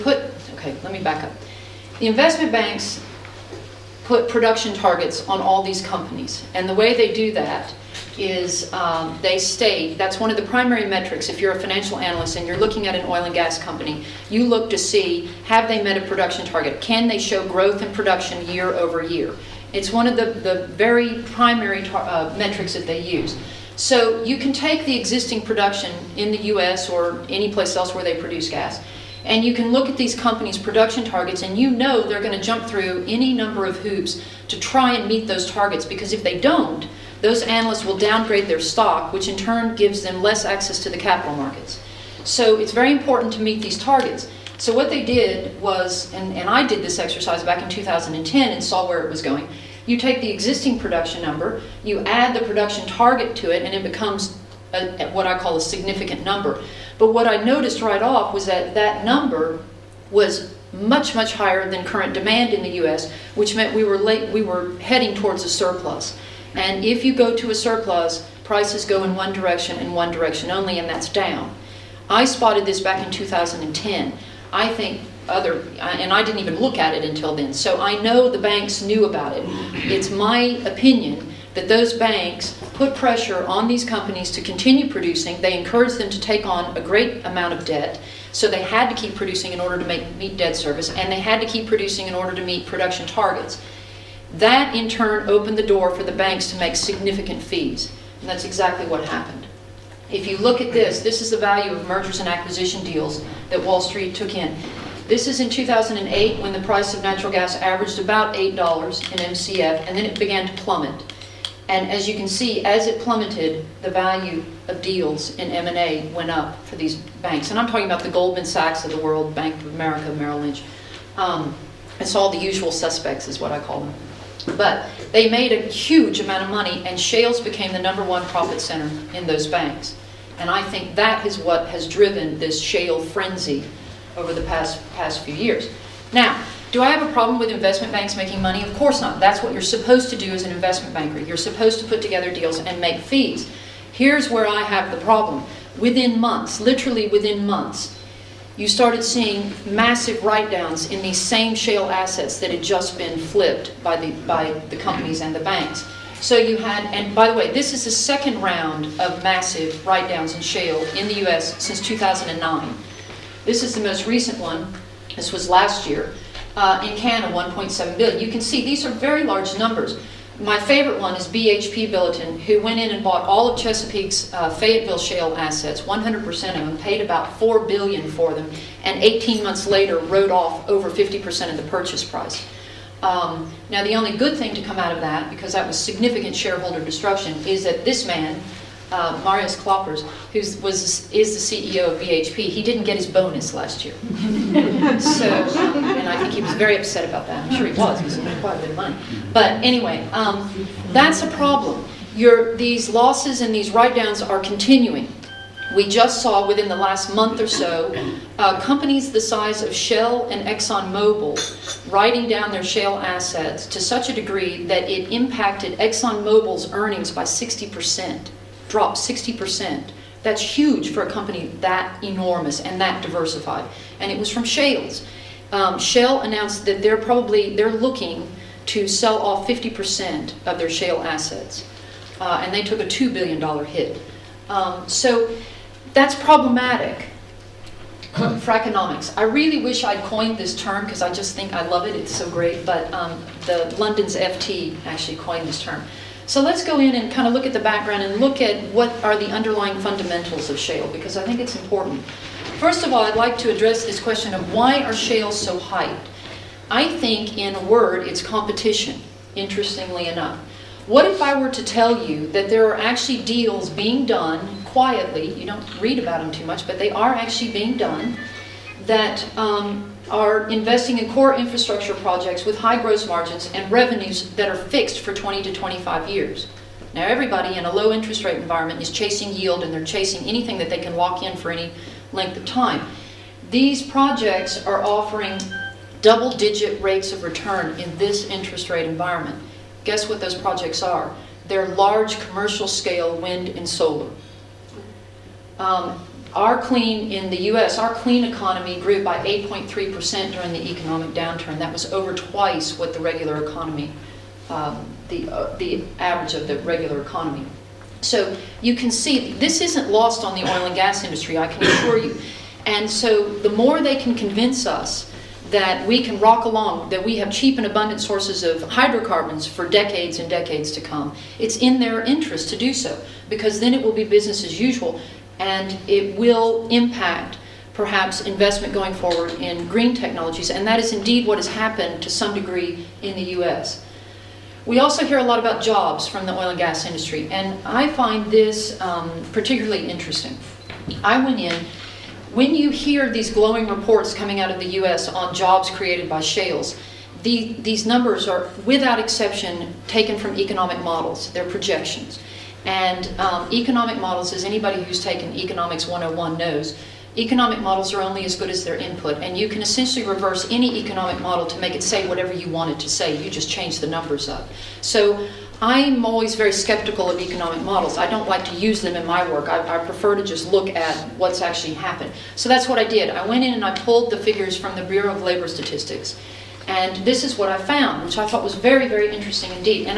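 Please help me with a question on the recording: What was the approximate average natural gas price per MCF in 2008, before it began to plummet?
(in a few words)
$8.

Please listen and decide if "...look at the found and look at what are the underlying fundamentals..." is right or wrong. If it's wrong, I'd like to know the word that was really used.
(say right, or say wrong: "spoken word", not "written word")
wrong: "background", not "found".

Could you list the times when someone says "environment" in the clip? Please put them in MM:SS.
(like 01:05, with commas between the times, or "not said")
04:38, 04:48.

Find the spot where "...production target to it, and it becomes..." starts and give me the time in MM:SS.
00:52.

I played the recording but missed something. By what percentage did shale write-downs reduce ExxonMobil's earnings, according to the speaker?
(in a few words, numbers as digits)
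60%.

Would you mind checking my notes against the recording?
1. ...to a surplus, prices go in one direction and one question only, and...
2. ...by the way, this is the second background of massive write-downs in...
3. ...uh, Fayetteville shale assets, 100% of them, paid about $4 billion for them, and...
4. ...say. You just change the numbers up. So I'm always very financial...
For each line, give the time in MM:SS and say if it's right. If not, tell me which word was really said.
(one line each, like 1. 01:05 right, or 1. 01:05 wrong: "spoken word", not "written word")
1. 01:07 wrong: "direction", not "question"
2. 02:37 wrong: "round", not "background"
3. 02:54 right
4. 06:02 wrong: "skeptical", not "financial".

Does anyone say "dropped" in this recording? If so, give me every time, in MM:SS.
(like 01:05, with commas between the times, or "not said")
03:38.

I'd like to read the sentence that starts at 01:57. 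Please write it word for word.
And I'm talking about the Goldman Sachs of the world, Bank of America, Merrill Lynch.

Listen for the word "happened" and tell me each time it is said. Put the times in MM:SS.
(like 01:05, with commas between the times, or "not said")
01:39, 05:31, 06:11.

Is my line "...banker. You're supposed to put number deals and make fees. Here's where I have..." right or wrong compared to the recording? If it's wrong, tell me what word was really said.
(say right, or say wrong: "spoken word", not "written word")
wrong: "together", not "number".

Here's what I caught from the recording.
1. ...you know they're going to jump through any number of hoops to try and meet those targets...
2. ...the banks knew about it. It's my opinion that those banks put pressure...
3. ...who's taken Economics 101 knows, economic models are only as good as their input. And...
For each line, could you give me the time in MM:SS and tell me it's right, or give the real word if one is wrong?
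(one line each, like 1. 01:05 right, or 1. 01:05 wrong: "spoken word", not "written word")
1. 00:31 right
2. 01:18 right
3. 05:54 right.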